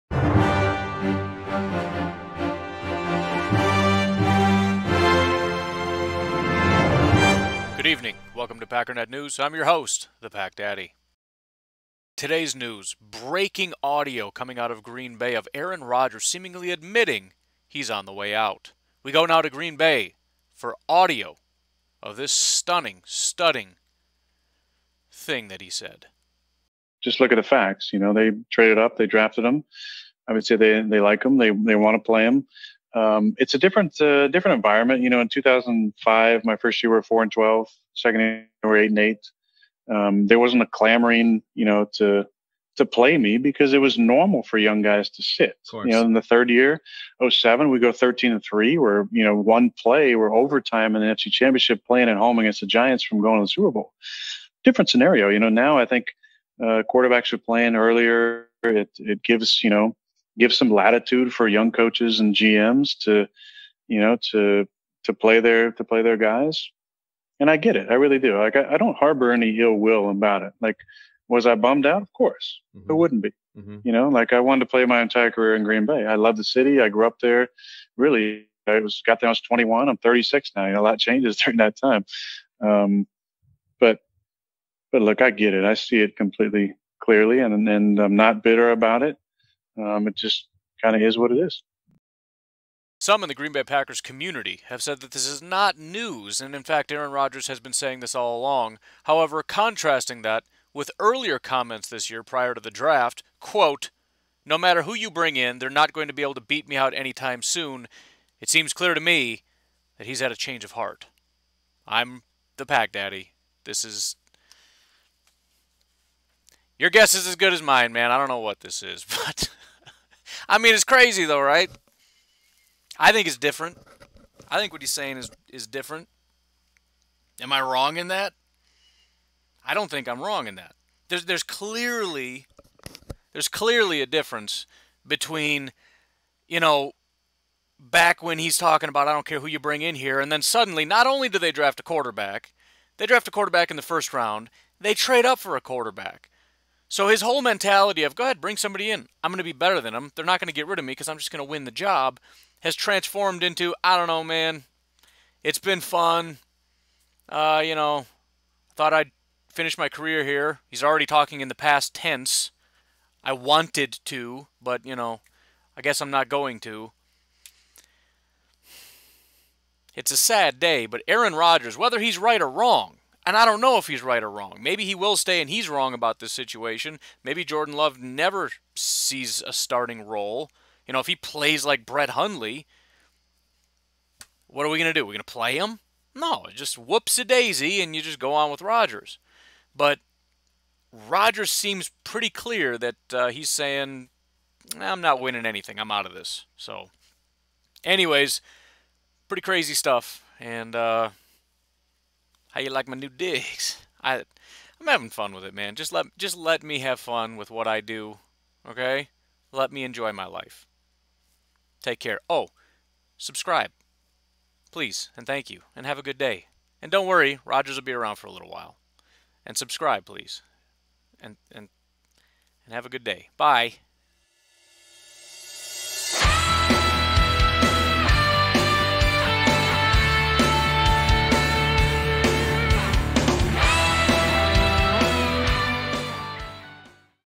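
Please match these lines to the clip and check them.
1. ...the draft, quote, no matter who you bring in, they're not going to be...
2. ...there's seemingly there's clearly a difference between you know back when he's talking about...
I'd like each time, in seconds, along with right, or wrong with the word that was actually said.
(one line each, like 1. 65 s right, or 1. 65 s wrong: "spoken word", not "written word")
1. 102 s right
2. 131 s wrong: "clearly", not "seemingly".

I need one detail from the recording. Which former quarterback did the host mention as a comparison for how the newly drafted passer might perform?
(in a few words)
Brett Hundley.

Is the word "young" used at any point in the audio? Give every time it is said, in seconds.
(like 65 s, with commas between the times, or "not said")
44 s, 61 s.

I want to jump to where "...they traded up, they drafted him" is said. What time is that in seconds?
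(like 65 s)
28 s.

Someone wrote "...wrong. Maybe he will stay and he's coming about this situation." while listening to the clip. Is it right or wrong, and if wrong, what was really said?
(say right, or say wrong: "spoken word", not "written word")
wrong: "wrong", not "coming".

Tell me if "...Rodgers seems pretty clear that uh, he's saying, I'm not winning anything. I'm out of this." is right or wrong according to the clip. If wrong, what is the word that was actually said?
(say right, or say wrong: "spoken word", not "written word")
right.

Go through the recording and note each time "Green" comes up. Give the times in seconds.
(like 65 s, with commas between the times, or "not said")
14 s, 19 s, 75 s, 93 s.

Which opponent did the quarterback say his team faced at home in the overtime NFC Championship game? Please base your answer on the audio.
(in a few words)
the Giants.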